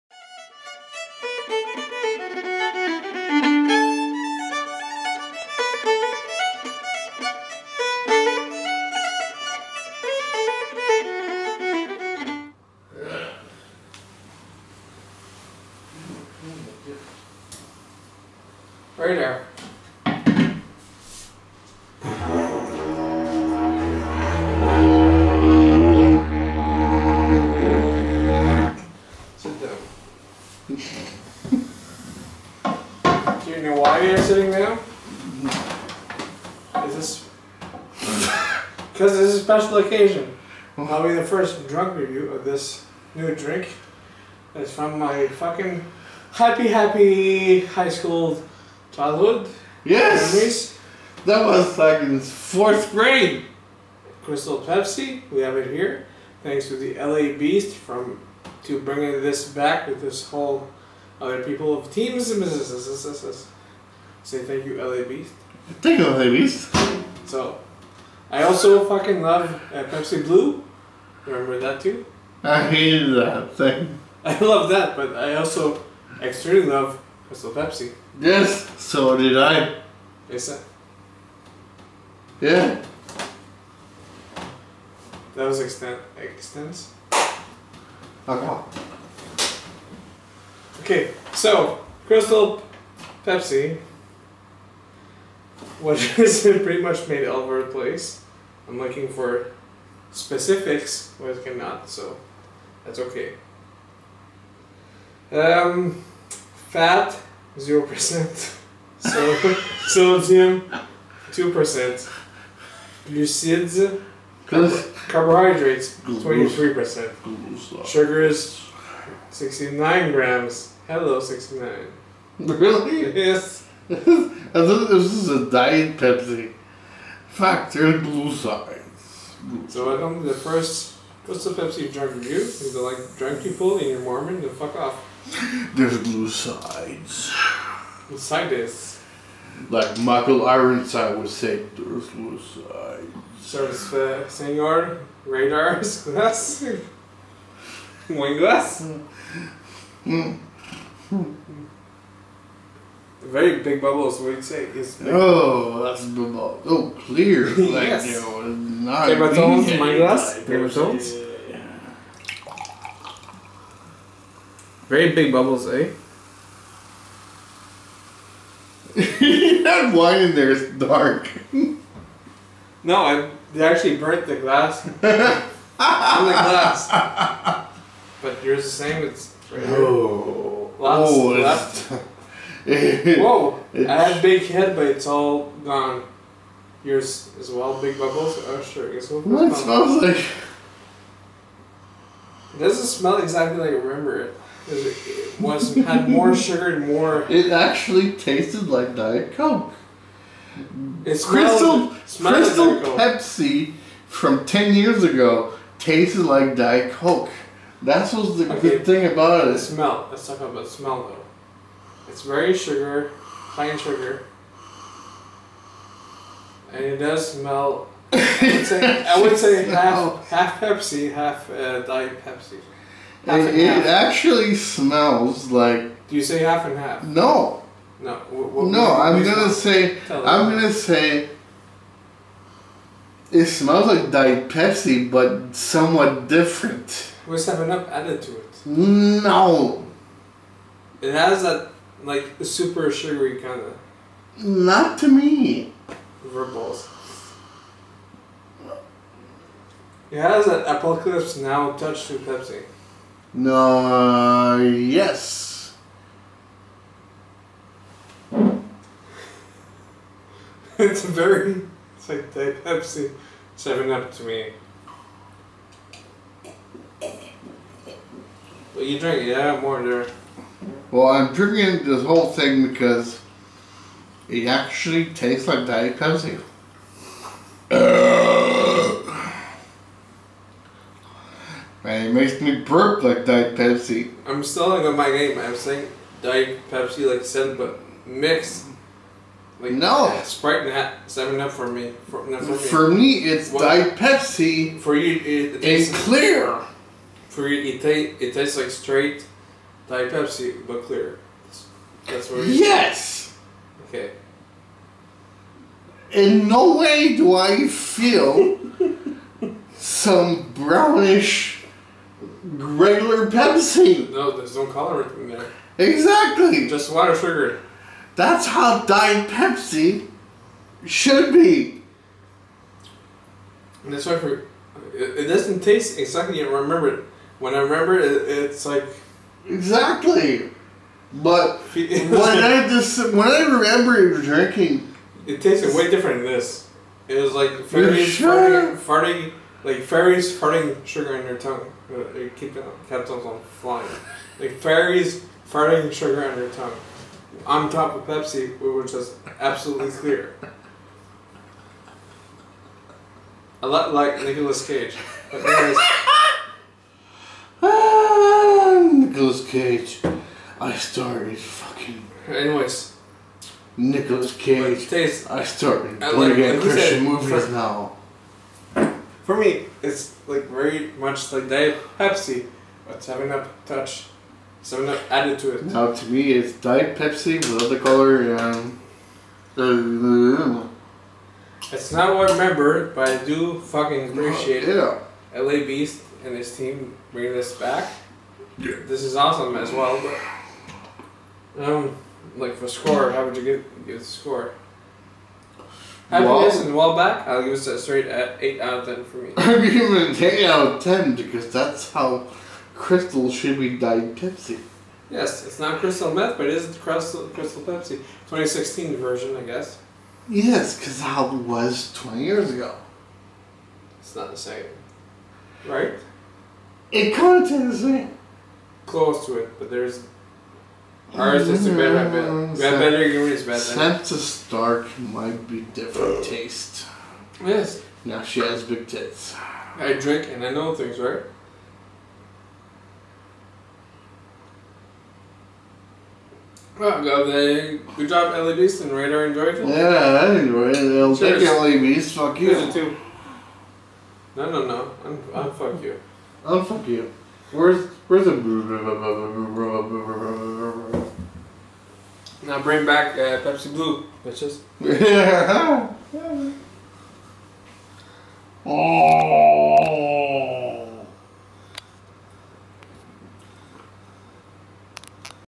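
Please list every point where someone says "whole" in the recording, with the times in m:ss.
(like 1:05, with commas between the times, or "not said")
1:00, 4:32.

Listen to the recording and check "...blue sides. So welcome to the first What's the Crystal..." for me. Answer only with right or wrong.
wrong.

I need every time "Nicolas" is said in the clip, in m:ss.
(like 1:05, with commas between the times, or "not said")
5:54, 5:58, 6:03.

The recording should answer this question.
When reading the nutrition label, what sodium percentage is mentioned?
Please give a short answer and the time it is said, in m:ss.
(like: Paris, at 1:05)
2%, at 1:51.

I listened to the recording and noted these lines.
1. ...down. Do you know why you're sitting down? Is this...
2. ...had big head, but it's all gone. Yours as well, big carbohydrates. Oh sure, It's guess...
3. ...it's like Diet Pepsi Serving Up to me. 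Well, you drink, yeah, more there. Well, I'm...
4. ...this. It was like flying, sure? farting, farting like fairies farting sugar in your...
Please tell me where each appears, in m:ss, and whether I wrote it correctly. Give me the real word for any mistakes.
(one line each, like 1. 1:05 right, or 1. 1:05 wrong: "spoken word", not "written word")
1. 0:29 right
2. 3:04 wrong: "bubbles", not "carbohydrates"
3. 4:21 right
4. 5:36 wrong: "farting", not "flying".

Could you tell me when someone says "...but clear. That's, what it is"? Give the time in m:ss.
5:00.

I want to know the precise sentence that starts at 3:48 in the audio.
What, what, no, I'm gonna say.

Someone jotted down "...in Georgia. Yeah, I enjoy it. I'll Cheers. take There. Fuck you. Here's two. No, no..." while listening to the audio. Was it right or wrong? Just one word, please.
wrong.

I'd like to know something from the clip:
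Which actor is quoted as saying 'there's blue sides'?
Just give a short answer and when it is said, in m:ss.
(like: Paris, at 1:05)
Michael Ironside, at 2:19.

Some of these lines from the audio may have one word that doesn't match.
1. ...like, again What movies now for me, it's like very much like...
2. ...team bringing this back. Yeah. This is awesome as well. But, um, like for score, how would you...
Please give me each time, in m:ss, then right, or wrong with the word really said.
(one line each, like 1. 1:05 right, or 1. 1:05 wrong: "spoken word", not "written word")
1. 6:06 wrong: "Christian", not "What"
2. 6:26 right.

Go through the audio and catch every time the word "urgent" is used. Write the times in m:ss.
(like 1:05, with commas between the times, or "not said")
not said.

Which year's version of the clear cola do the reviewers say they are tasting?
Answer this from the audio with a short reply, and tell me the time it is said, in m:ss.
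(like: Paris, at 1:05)
2016, at 6:48.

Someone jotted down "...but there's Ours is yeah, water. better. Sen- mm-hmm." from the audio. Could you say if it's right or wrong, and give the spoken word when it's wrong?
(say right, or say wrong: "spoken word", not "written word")
wrong: "better", not "water".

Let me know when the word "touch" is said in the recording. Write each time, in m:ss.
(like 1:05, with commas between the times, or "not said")
4:11, 6:13.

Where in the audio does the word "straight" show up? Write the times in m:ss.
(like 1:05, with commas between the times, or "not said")
4:58, 6:37.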